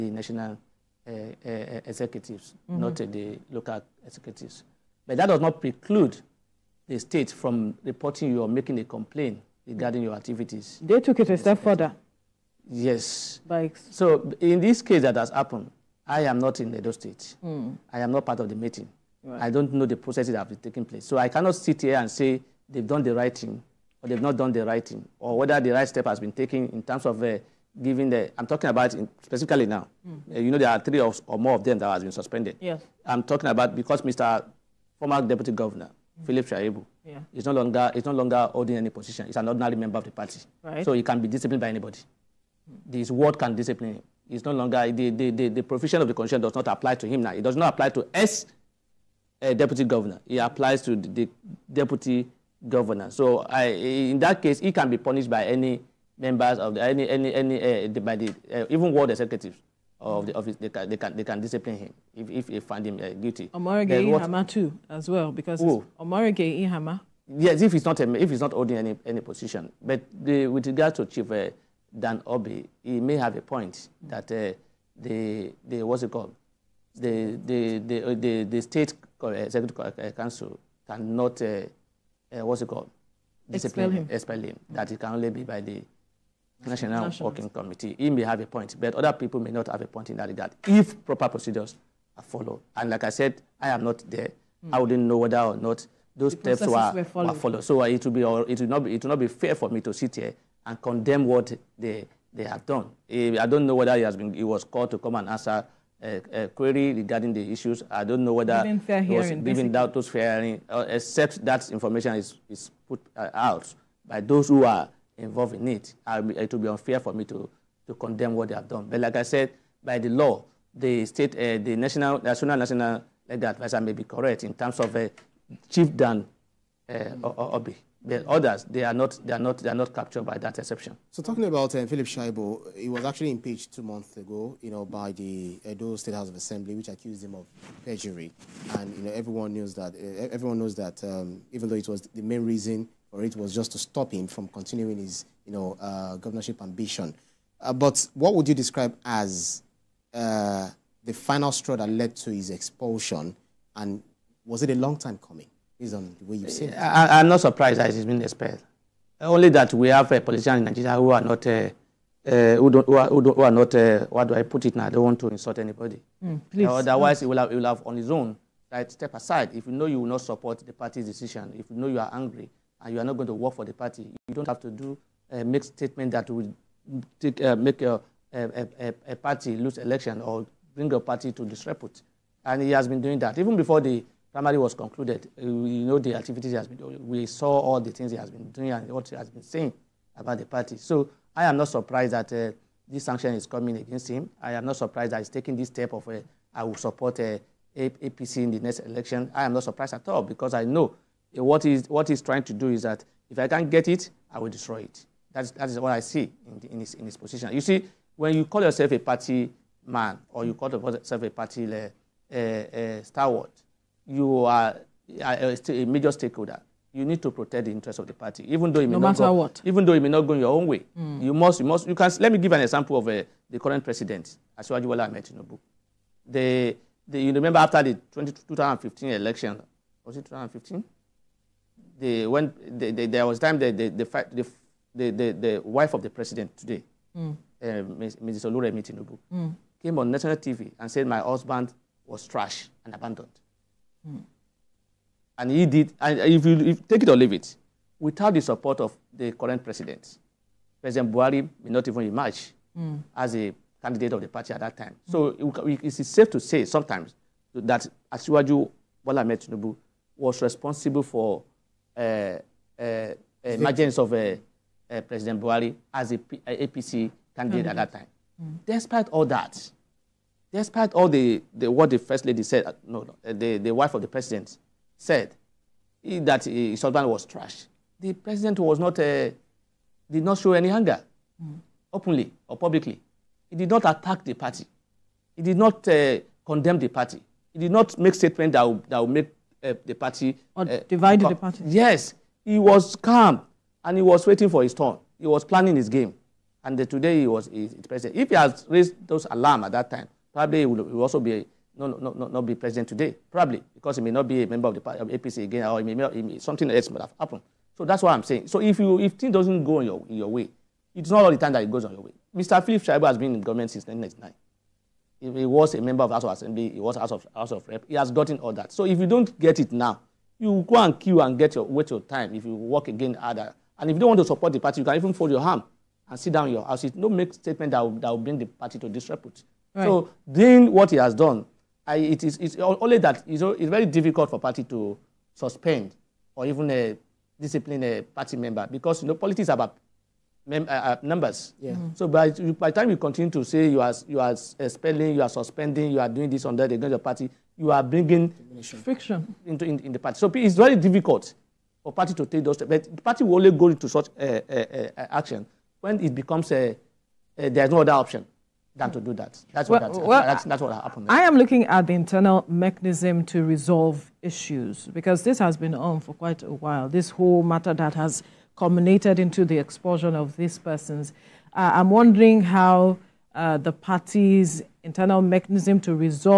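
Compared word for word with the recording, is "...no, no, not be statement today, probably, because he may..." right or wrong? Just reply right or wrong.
wrong.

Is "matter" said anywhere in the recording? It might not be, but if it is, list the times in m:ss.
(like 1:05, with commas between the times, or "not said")
3:39, 6:07.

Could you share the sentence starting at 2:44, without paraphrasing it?
I don't want to insult anybody.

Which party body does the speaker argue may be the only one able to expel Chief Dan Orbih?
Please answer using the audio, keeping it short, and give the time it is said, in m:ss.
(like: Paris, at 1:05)
National Working Committee, at 1:27.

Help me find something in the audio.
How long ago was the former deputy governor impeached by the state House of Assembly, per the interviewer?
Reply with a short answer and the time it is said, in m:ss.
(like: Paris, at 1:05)
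2 months, at 2:13.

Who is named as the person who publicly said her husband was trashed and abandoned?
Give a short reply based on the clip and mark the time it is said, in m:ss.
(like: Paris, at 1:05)
Oluremi Tinubu, at 3:58.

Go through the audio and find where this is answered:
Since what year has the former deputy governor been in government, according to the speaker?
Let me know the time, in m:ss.
5:13.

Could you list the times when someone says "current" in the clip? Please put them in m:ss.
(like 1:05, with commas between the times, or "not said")
3:43, 4:09.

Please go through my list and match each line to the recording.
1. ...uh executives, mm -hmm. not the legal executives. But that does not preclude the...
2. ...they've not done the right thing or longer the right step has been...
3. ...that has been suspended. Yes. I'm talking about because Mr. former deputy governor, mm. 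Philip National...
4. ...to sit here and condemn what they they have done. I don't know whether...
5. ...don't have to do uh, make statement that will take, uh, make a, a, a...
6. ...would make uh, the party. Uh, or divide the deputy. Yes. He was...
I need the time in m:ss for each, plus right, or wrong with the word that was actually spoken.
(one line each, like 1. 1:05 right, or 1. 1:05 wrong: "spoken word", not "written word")
1. 0:01 wrong: "local", not "legal"
2. 0:24 wrong: "whether", not "longer"
3. 0:31 wrong: "Shaibu", not "National"
4. 1:39 right
5. 2:54 right
6. 4:48 wrong: "party", not "deputy".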